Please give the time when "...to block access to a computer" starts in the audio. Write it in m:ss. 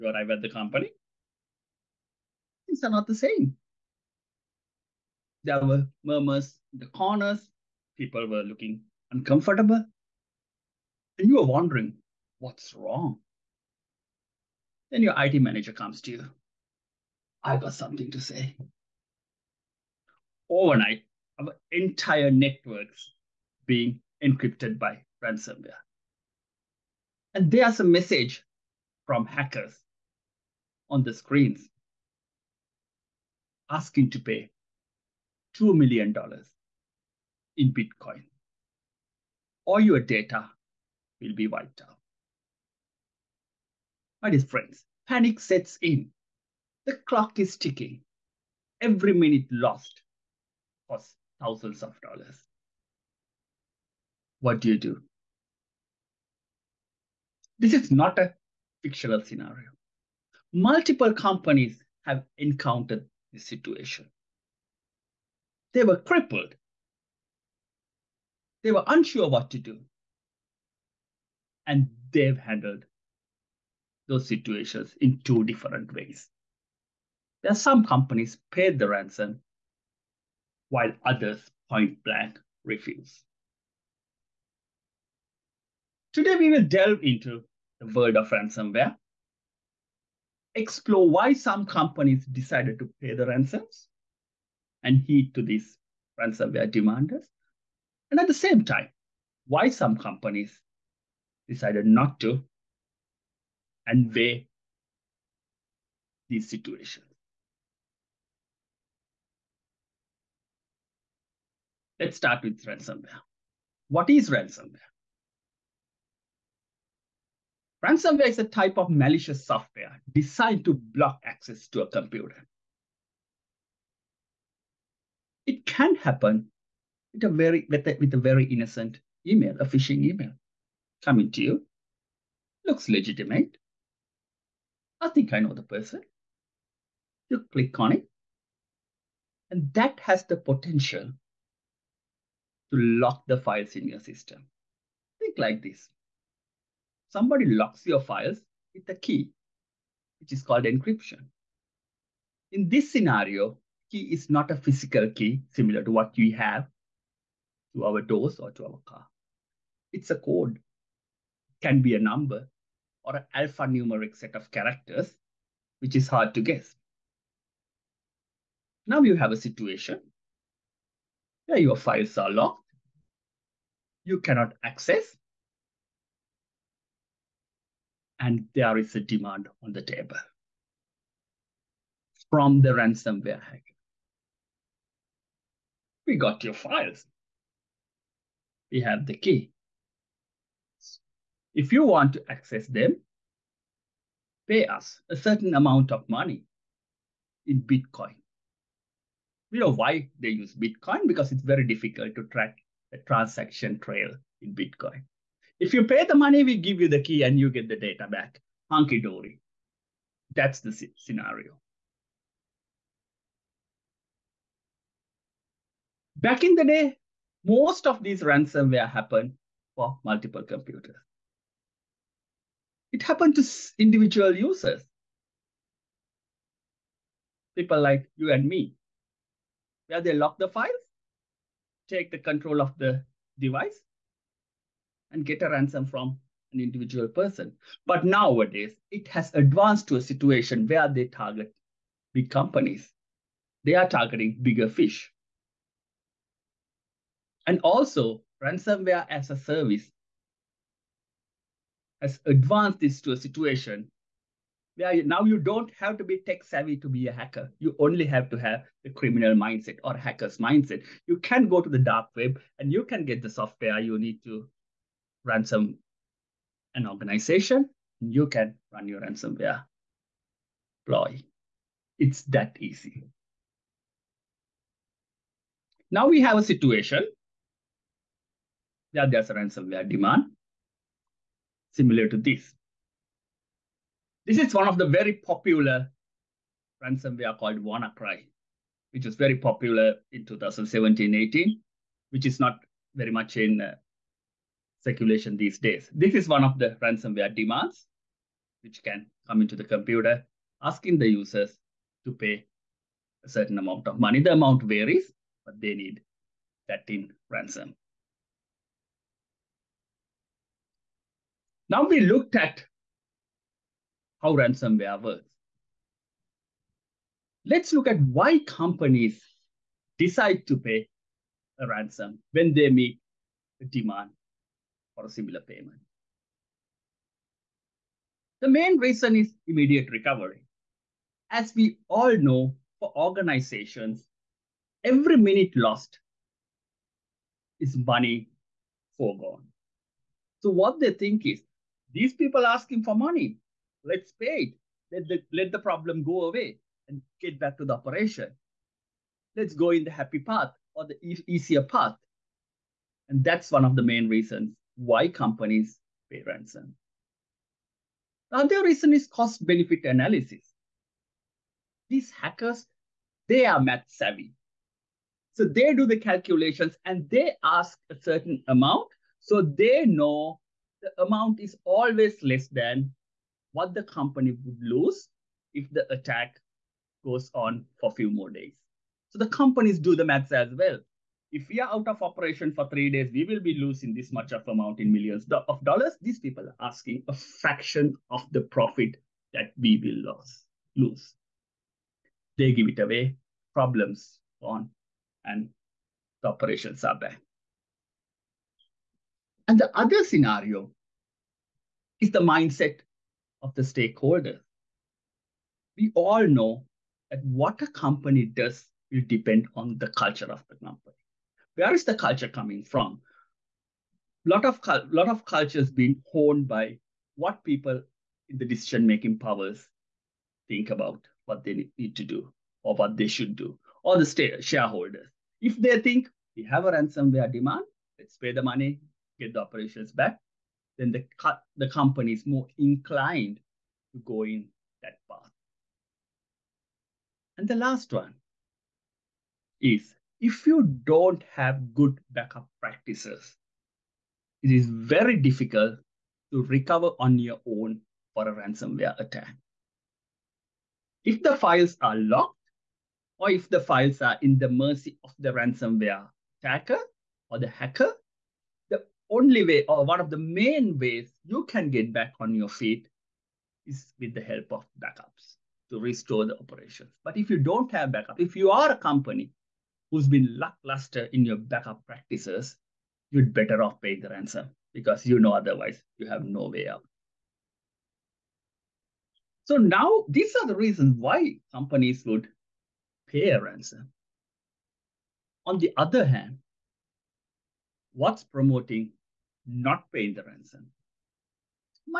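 2:00.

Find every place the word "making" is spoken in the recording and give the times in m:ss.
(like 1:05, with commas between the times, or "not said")
6:58.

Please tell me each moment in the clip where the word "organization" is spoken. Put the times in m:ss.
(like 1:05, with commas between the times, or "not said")
4:26, 5:32.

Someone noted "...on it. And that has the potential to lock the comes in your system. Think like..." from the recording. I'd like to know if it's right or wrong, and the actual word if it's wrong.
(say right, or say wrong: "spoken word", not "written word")
wrong: "files", not "comes".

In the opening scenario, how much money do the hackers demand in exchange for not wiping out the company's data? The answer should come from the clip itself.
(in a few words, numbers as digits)
$2 million.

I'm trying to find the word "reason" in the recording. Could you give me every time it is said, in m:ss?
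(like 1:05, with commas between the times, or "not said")
5:28, 5:54, 5:58, 8:00.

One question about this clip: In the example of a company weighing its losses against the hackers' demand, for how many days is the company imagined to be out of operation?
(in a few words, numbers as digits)
3.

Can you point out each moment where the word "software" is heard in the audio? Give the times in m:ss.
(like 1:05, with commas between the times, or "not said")
1:59, 4:23.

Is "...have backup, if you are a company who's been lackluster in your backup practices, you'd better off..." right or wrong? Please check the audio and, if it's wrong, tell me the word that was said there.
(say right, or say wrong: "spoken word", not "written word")
right.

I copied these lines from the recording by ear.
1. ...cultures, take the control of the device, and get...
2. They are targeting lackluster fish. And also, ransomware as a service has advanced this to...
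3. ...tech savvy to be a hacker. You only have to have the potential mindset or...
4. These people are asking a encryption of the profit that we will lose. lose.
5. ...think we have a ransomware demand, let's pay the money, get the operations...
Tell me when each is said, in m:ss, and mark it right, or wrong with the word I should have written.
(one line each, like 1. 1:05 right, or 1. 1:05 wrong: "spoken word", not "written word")
1. 3:50 wrong: "files", not "cultures"
2. 4:03 wrong: "bigger", not "lackluster"
3. 4:16 wrong: "criminal", not "potential"
4. 6:26 wrong: "fraction", not "encryption"
5. 7:05 right.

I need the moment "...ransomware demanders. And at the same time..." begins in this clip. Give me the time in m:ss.
1:36.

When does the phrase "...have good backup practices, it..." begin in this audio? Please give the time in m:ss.
7:21.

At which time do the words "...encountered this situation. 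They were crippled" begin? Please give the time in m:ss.
1:02.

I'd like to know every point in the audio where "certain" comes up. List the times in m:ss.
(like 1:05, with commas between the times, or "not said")
3:15, 5:03, 6:07.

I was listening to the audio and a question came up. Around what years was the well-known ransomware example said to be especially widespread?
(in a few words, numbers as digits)
2017-18.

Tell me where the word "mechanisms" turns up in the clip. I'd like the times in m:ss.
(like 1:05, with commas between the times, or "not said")
not said.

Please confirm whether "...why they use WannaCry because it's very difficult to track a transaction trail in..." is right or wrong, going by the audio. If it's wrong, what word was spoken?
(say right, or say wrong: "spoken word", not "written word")
wrong: "Bitcoin", not "WannaCry".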